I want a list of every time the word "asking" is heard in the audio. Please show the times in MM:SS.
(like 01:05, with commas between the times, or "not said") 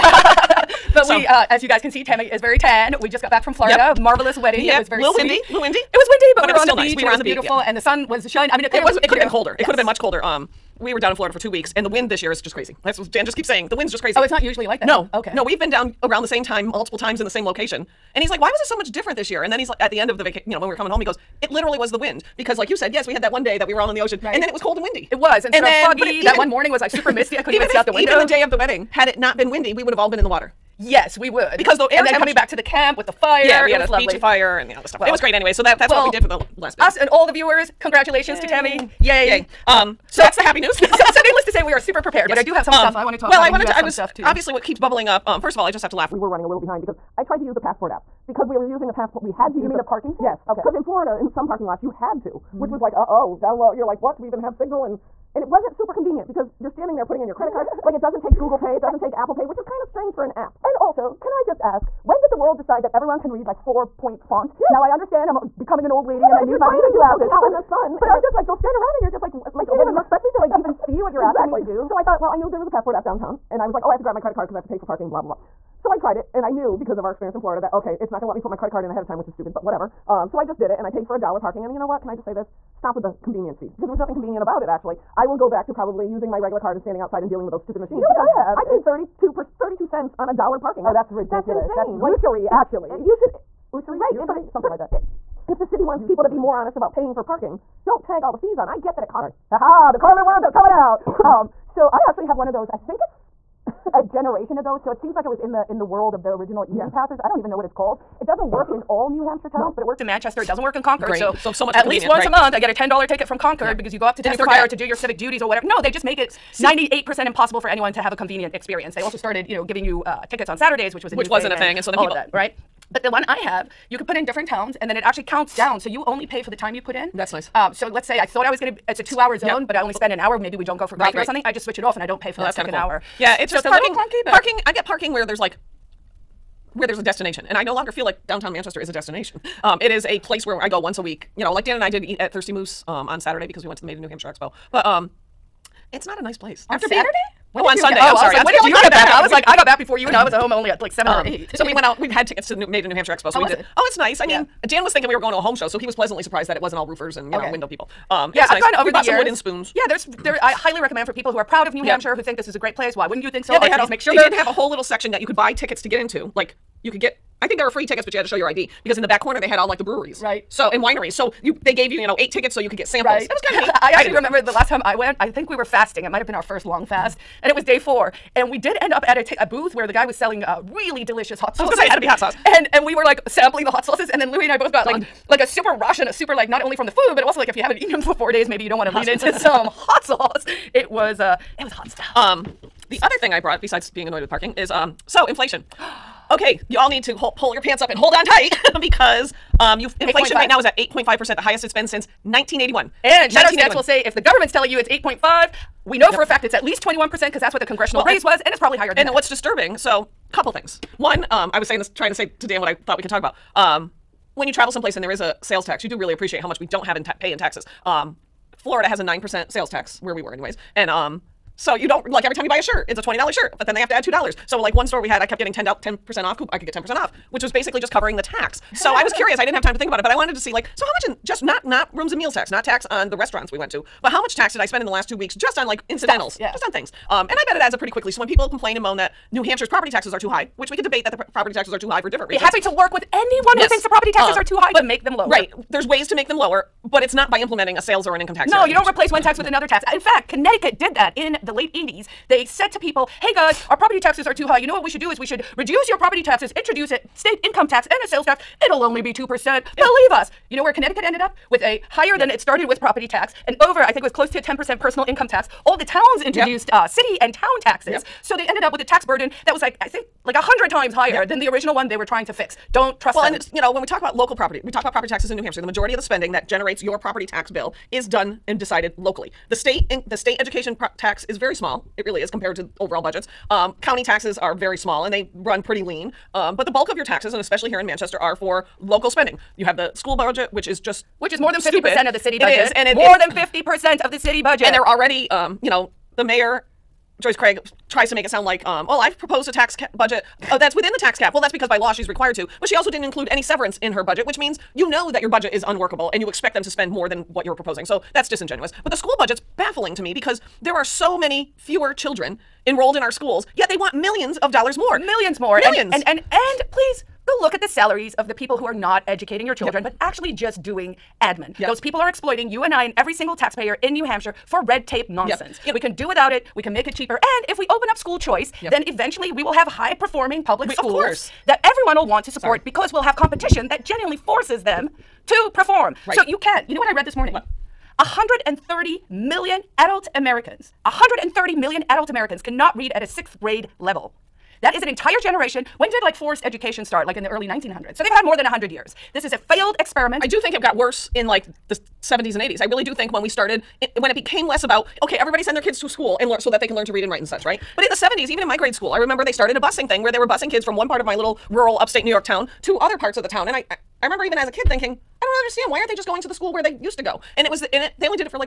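01:11.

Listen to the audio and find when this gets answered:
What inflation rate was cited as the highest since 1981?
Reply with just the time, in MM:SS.
03:20.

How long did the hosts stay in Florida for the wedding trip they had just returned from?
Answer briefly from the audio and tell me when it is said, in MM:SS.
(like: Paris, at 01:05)
2 weeks, at 00:11.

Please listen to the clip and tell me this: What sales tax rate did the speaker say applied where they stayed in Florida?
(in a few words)
9%.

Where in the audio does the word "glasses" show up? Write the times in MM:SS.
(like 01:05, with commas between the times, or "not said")
01:06.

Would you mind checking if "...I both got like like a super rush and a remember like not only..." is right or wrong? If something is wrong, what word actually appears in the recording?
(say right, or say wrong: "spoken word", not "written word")
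wrong: "super", not "remember".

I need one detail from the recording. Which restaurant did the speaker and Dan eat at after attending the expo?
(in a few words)
Thirsty Moose.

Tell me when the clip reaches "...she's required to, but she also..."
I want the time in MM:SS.
05:01.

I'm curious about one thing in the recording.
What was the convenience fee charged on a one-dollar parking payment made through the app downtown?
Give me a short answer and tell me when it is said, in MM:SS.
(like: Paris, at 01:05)
32 cents, at 01:29.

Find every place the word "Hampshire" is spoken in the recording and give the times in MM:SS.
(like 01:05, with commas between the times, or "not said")
01:49, 02:24, 02:32, 02:41, 03:59, 04:35, 05:24.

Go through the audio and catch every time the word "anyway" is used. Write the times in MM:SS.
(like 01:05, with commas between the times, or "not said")
00:35, 03:40.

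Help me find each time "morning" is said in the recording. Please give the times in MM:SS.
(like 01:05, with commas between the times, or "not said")
00:26, 05:37.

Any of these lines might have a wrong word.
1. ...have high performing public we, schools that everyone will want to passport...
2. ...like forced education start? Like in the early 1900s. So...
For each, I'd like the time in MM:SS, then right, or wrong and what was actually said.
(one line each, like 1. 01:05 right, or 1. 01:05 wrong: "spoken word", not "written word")
1. 05:29 wrong: "support", not "passport"
2. 05:46 right.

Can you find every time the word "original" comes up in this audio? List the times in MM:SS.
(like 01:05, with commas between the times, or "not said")
01:46, 04:31.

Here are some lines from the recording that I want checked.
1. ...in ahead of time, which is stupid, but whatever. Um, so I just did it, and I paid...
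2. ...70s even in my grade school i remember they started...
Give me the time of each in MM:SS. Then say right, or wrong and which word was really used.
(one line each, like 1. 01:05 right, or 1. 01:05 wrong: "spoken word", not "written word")
1. 01:18 right
2. 05:57 right.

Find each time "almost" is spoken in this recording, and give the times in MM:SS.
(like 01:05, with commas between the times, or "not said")
not said.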